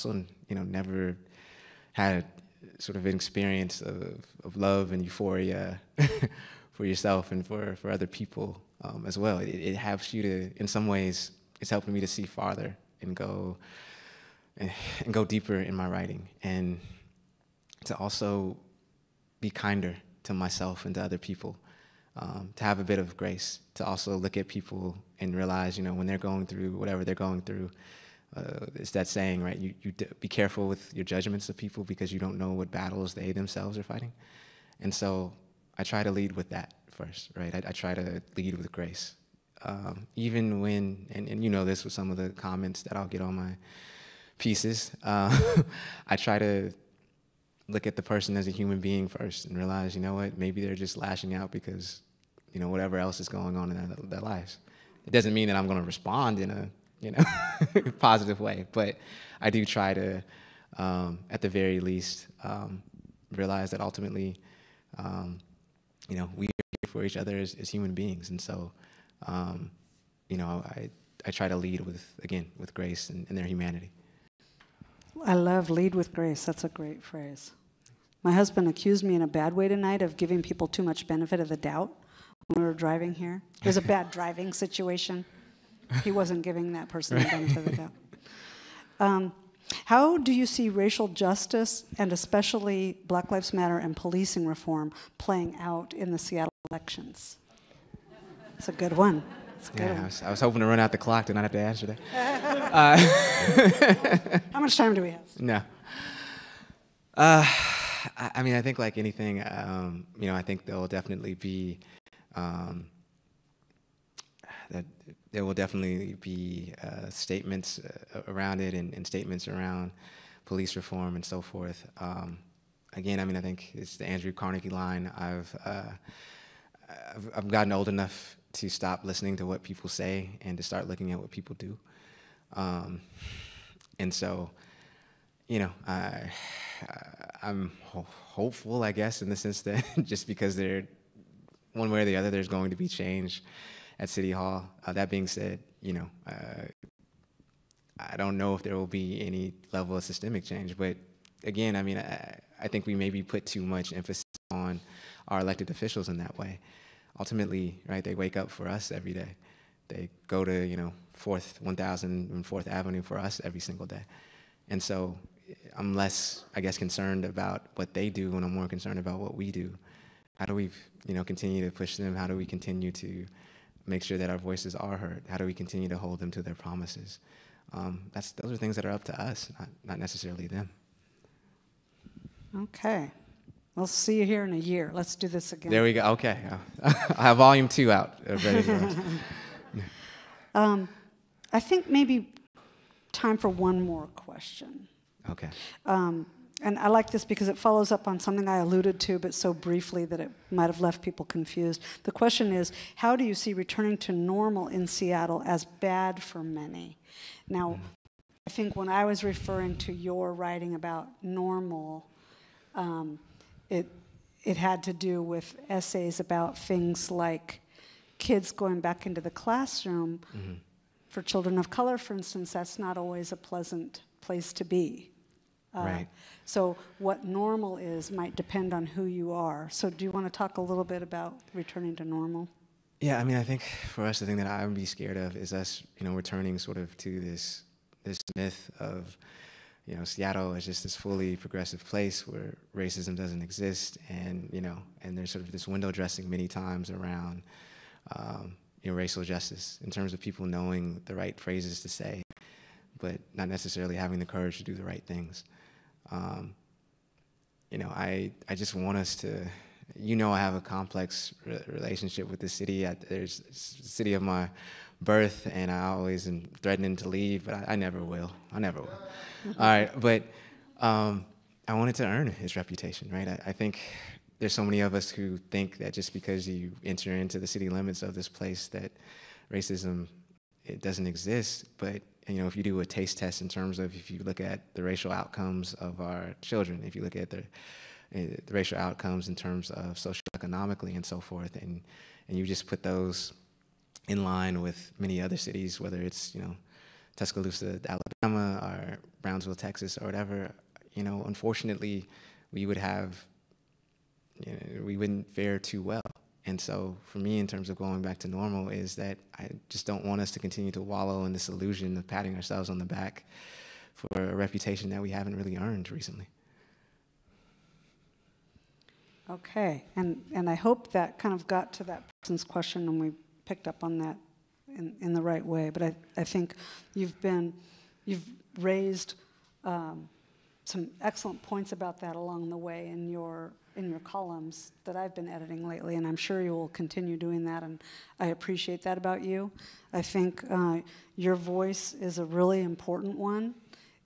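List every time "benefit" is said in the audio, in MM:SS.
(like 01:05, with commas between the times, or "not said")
01:21, 01:27.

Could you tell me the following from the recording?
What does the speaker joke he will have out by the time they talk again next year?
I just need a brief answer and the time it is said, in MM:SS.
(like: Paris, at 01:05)
Volume two, at 03:07.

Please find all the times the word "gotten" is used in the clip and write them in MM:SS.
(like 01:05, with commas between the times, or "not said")
02:07.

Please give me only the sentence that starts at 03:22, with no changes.
The question is how do you see returning to normal in Seattle as bad for many?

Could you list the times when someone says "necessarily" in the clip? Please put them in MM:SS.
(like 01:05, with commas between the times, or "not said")
02:59, 04:13.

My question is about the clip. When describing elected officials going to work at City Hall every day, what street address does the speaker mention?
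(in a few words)
1000 4th Avenue.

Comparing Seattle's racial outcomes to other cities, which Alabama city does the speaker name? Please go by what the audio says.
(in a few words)
Tuscaloosa.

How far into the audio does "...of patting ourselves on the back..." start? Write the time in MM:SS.
05:11.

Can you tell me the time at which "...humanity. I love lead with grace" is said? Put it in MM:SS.
01:13.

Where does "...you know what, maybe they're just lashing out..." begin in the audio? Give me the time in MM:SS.
00:49.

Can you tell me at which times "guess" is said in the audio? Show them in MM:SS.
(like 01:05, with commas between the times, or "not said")
02:18, 02:46.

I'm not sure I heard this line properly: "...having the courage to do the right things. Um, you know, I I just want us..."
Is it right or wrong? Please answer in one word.
right.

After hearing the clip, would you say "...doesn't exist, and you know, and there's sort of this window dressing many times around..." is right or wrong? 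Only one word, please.
right.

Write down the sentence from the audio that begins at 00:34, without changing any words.
And so I try to lead with that first, right?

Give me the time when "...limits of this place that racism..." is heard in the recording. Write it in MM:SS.
04:37.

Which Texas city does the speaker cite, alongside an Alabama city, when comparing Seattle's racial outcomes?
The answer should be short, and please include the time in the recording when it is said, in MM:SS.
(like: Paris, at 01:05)
Brownsville, at 04:59.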